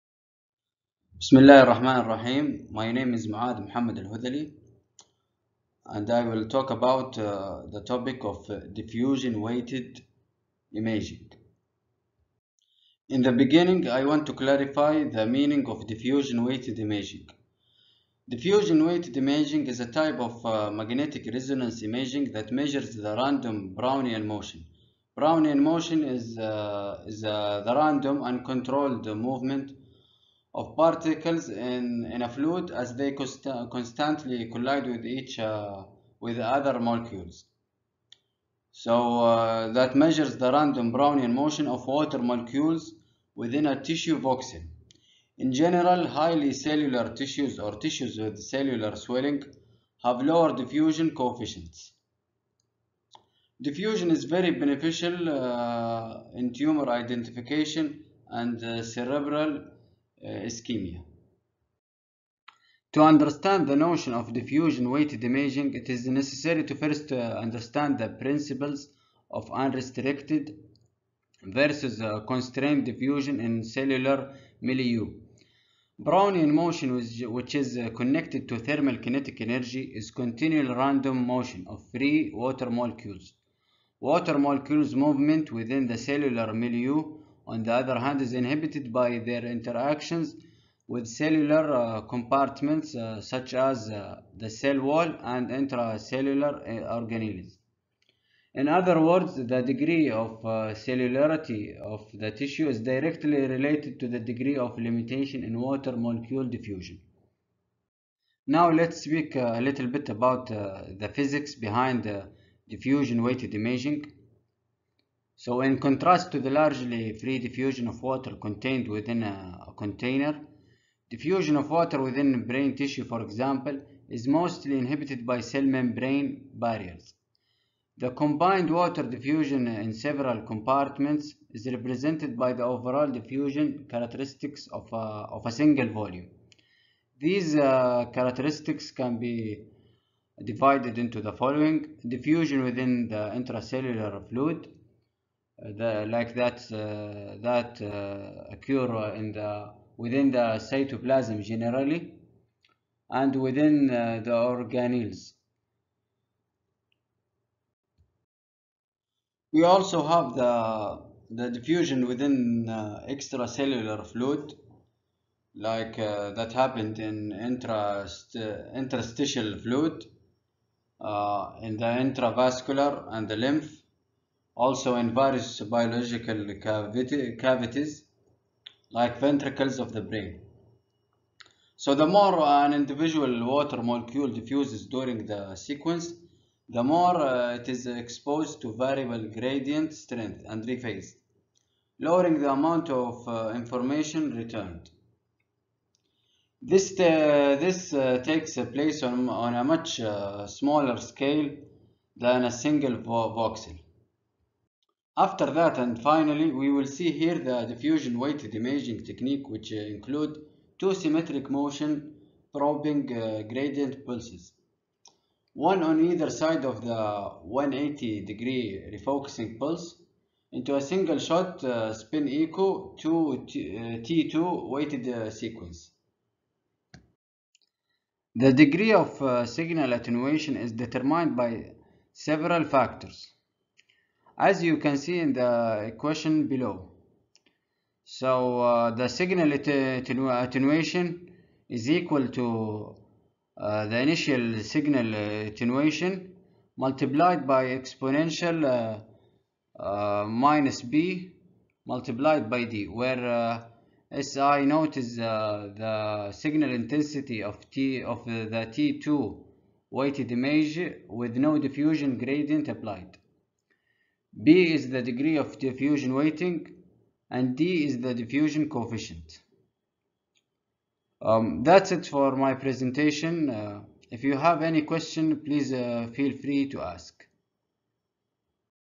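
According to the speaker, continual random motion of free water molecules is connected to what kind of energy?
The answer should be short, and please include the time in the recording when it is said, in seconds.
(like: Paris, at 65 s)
Thermal kinetic energy, at 78 s.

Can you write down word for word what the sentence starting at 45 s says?
In general, highly cellular tissues or tissues with cellular swelling have lower diffusion coefficients.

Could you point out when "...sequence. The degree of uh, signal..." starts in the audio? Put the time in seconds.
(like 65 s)
225 s.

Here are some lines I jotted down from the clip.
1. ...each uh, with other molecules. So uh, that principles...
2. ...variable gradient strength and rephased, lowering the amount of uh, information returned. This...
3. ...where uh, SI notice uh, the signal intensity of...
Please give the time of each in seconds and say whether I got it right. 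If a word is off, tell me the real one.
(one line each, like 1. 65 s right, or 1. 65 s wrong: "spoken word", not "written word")
1. 35 s wrong: "measures", not "principles"
2. 188 s right
3. 252 s right.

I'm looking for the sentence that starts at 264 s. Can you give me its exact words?
B is the degree of diffusion weighting and D is the diffusion coefficient.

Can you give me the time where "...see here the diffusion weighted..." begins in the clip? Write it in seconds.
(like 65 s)
206 s.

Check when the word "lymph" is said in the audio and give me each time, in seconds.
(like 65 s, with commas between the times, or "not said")
173 s.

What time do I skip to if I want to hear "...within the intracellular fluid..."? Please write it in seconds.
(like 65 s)
142 s.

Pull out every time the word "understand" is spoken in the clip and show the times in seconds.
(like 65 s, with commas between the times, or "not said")
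63 s, 67 s.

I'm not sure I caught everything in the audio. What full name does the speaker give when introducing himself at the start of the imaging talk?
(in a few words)
Maad Muhammad Al-Hudali.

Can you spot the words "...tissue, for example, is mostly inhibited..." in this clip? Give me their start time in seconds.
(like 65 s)
122 s.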